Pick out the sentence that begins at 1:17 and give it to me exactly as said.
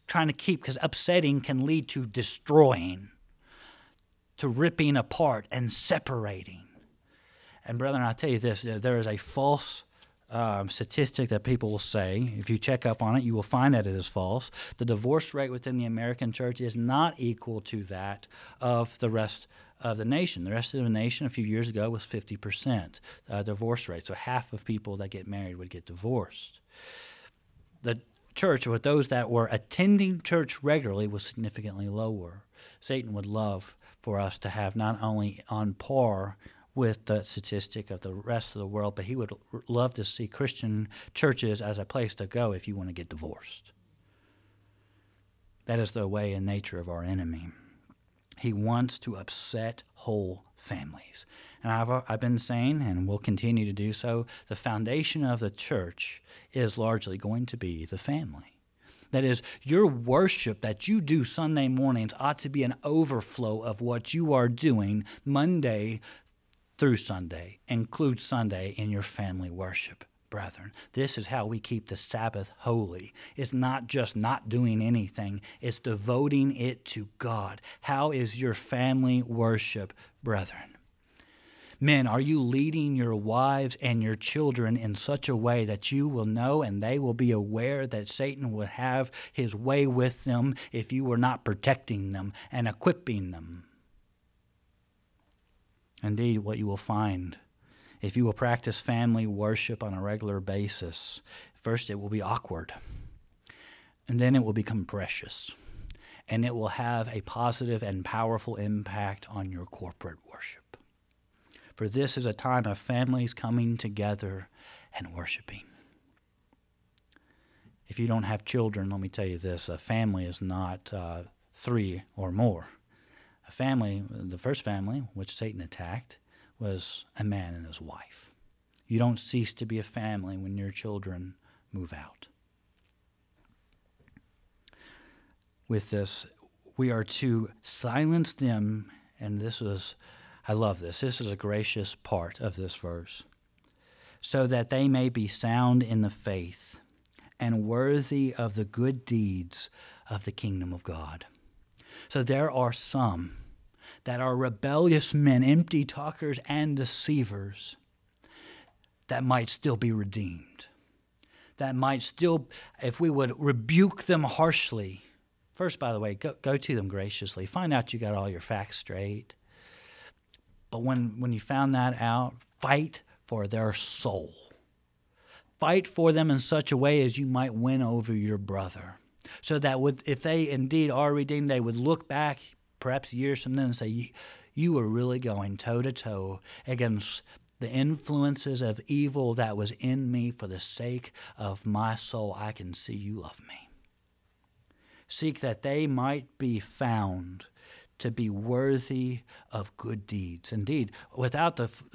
How is your family worship, brethren?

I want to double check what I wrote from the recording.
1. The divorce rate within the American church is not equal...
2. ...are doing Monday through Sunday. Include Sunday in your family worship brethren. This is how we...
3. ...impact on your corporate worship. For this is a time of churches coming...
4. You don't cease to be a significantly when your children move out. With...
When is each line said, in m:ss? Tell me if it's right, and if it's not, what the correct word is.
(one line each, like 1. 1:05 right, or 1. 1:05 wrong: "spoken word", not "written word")
1. 0:14 right
2. 1:04 right
3. 1:48 wrong: "families", not "churches"
4. 2:08 wrong: "family", not "significantly".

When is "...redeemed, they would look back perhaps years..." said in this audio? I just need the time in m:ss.
3:01.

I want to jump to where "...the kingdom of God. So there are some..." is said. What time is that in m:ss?
2:30.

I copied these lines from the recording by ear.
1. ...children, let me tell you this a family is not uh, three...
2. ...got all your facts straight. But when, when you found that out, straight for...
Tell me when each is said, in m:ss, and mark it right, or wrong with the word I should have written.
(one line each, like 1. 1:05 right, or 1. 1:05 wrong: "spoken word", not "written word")
1. 1:58 right
2. 2:47 wrong: "fight", not "straight".